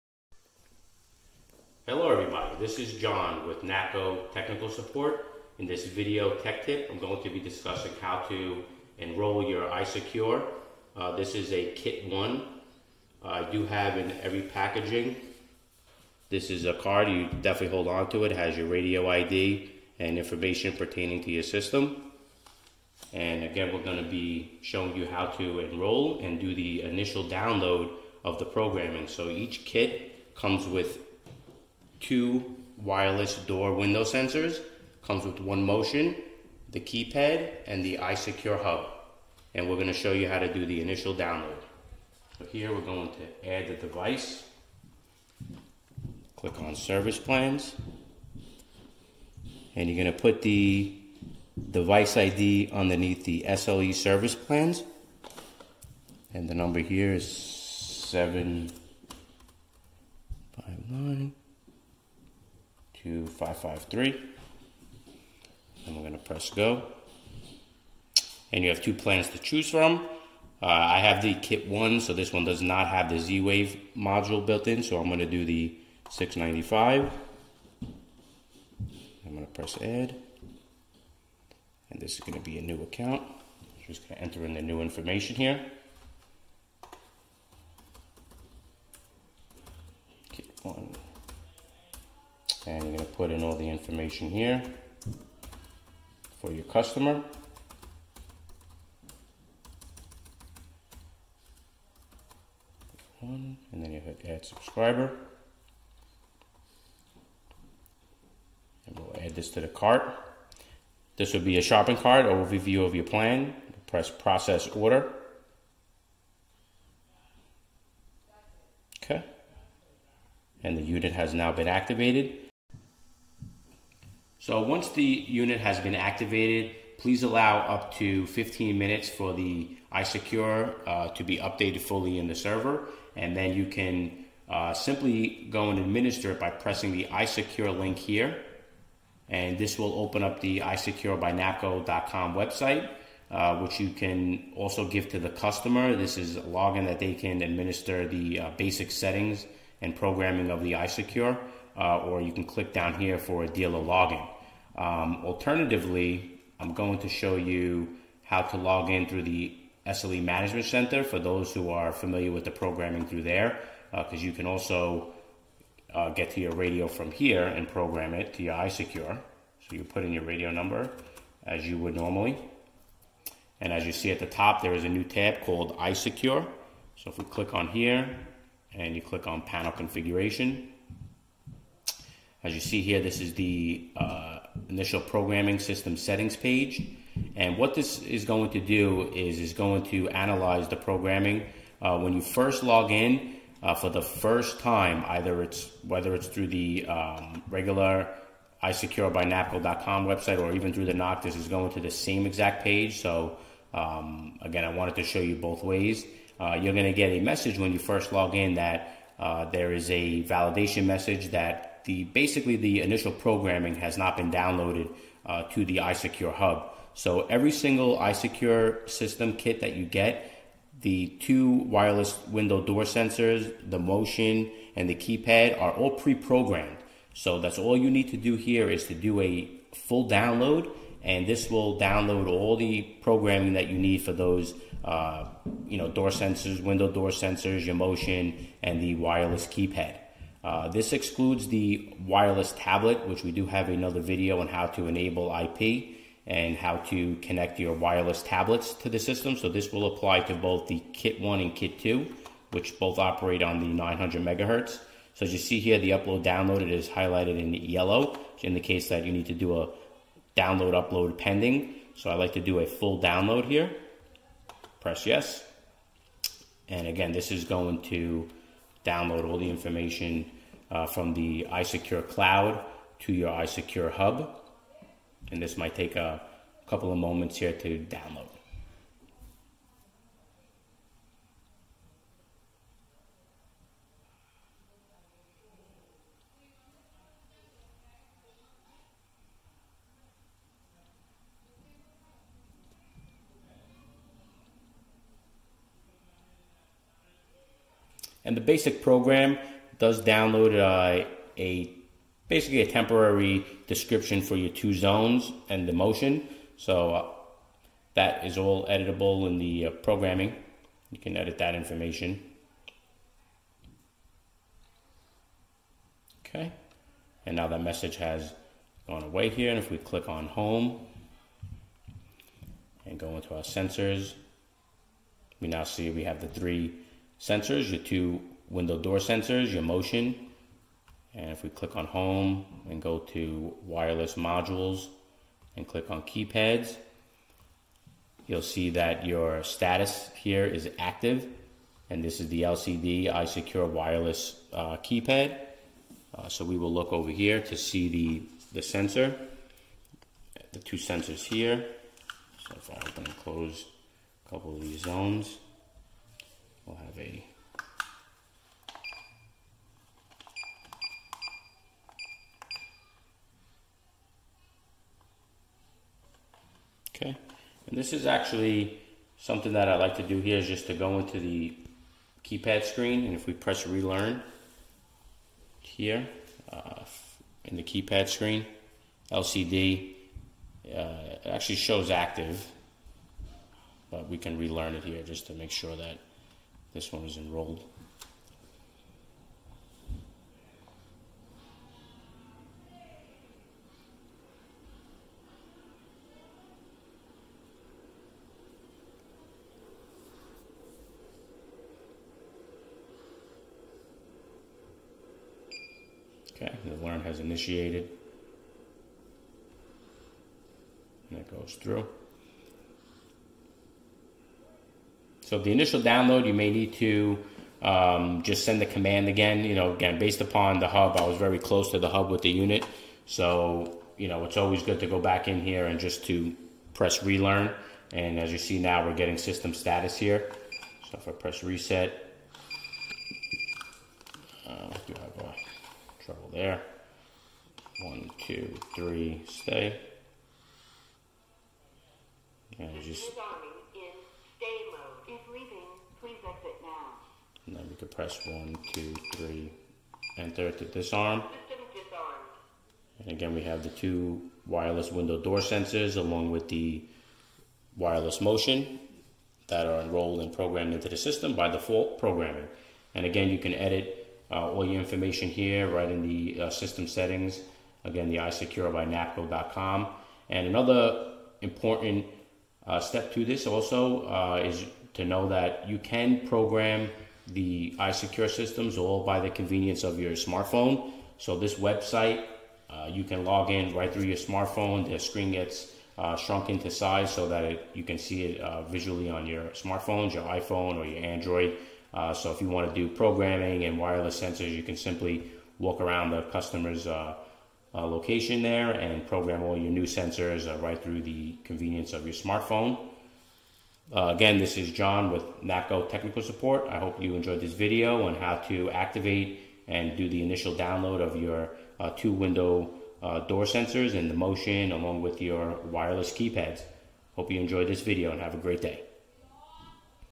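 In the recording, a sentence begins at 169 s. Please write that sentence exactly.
So you put in your radio number as you would normally.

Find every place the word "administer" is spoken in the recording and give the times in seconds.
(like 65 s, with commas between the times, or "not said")
135 s, 147 s.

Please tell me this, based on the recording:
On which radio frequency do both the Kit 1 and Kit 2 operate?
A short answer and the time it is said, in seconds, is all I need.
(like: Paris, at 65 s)
900 megahertz, at 253 s.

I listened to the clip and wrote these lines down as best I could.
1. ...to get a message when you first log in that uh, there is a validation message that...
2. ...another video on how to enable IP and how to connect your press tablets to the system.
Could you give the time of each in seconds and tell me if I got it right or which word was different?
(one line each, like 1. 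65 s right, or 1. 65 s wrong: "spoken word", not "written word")
1. 206 s right
2. 243 s wrong: "wireless", not "press".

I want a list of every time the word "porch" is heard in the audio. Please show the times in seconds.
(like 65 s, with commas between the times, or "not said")
not said.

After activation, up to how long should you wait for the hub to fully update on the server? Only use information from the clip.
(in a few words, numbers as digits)
15 minutes.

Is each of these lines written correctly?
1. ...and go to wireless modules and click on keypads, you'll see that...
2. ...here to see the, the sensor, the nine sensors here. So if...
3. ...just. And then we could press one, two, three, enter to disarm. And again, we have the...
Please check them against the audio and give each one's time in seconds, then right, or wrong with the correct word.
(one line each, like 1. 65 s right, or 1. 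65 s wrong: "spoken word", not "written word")
1. 332 s right
2. 347 s wrong: "two", not "nine"
3. 442 s right.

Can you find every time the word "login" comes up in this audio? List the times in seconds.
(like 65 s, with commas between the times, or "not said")
146 s, 153 s.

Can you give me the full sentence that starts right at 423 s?
So, you know, it's always good to go back in here and just to press relearn.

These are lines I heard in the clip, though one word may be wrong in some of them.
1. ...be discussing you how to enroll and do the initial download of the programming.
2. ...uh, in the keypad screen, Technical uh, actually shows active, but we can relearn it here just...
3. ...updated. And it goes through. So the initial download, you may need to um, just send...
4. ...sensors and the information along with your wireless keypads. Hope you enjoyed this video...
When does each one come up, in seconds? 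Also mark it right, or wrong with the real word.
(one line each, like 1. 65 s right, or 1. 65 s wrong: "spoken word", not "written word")
1. 24 s wrong: "showing", not "discussing"
2. 376 s wrong: "LCD", not "Technical"
3. 407 s wrong: "initiated", not "updated"
4. 513 s wrong: "motion", not "information".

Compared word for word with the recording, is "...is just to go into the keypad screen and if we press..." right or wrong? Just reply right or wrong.
right.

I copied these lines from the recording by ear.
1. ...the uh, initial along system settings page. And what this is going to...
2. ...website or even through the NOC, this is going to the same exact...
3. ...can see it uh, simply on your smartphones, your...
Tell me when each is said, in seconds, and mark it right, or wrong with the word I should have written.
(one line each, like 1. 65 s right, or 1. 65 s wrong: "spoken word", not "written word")
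1. 183 s wrong: "programming", not "along"
2. 200 s right
3. 487 s wrong: "visually", not "simply".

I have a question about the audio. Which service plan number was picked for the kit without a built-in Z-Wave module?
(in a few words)
695.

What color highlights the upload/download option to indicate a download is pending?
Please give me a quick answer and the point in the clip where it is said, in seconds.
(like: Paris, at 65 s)
yellow, at 257 s.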